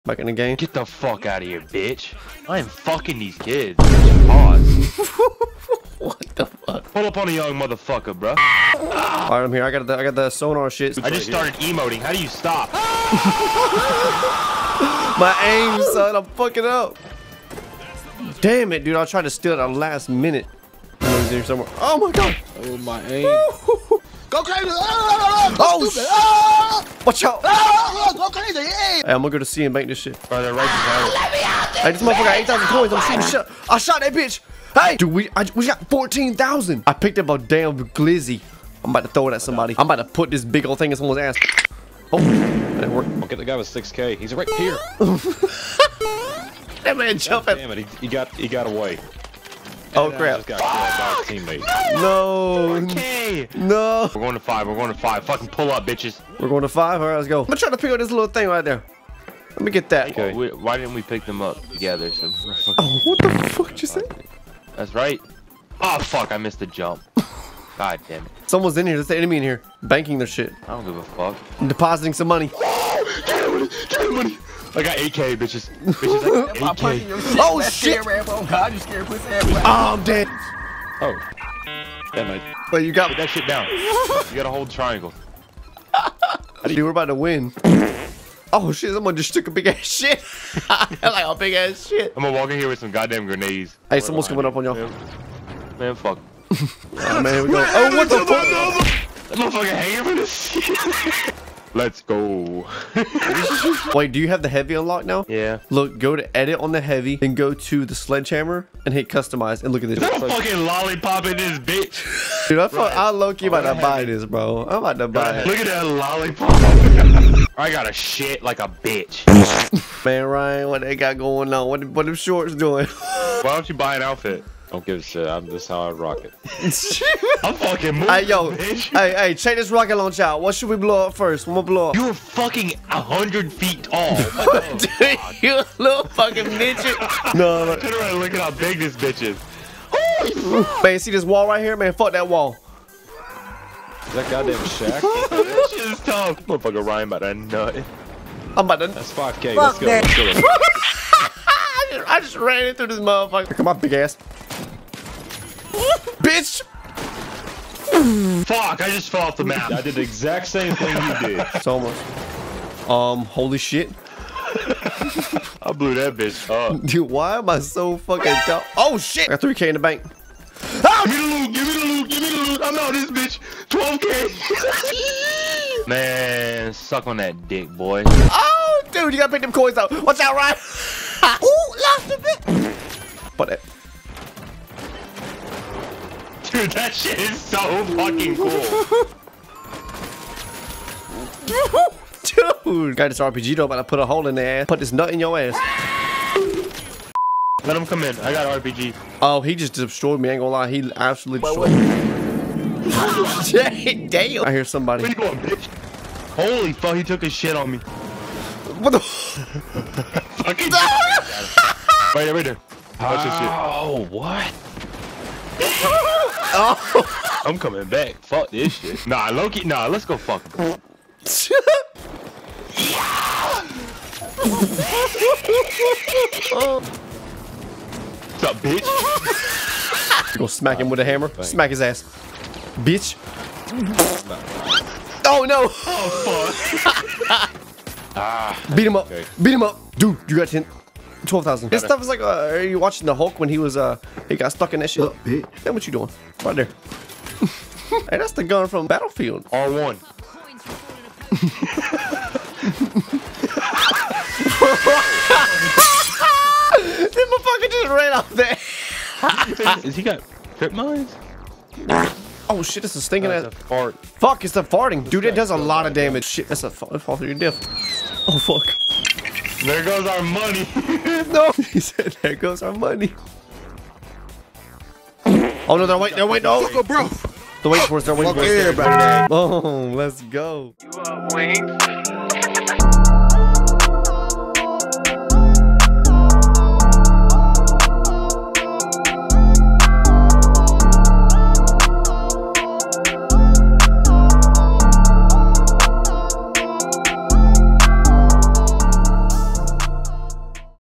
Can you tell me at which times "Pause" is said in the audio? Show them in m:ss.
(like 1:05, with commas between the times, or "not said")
0:03.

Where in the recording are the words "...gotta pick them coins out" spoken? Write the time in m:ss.
2:59.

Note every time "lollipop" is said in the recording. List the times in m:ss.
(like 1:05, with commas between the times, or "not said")
1:50, 1:55.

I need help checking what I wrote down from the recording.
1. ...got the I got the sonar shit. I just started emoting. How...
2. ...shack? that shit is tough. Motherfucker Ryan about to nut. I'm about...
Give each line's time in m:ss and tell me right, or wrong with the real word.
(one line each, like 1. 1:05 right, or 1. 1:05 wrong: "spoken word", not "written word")
1. 0:09 right
2. 2:24 right.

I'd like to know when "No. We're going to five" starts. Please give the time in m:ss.
0:53.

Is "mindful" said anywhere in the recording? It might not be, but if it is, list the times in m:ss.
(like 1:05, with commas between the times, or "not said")
not said.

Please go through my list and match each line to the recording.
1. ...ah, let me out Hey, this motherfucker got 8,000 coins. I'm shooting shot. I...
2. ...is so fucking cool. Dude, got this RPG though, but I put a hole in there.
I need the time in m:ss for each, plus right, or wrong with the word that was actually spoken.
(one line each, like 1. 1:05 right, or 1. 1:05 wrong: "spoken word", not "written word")
1. 0:30 right
2. 3:07 right.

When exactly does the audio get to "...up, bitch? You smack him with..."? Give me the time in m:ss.
3:48.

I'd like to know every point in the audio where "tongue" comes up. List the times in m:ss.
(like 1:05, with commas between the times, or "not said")
not said.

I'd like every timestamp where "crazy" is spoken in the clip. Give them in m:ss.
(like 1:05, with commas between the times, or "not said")
0:24.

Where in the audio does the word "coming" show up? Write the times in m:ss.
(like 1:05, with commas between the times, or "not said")
1:34, 3:37.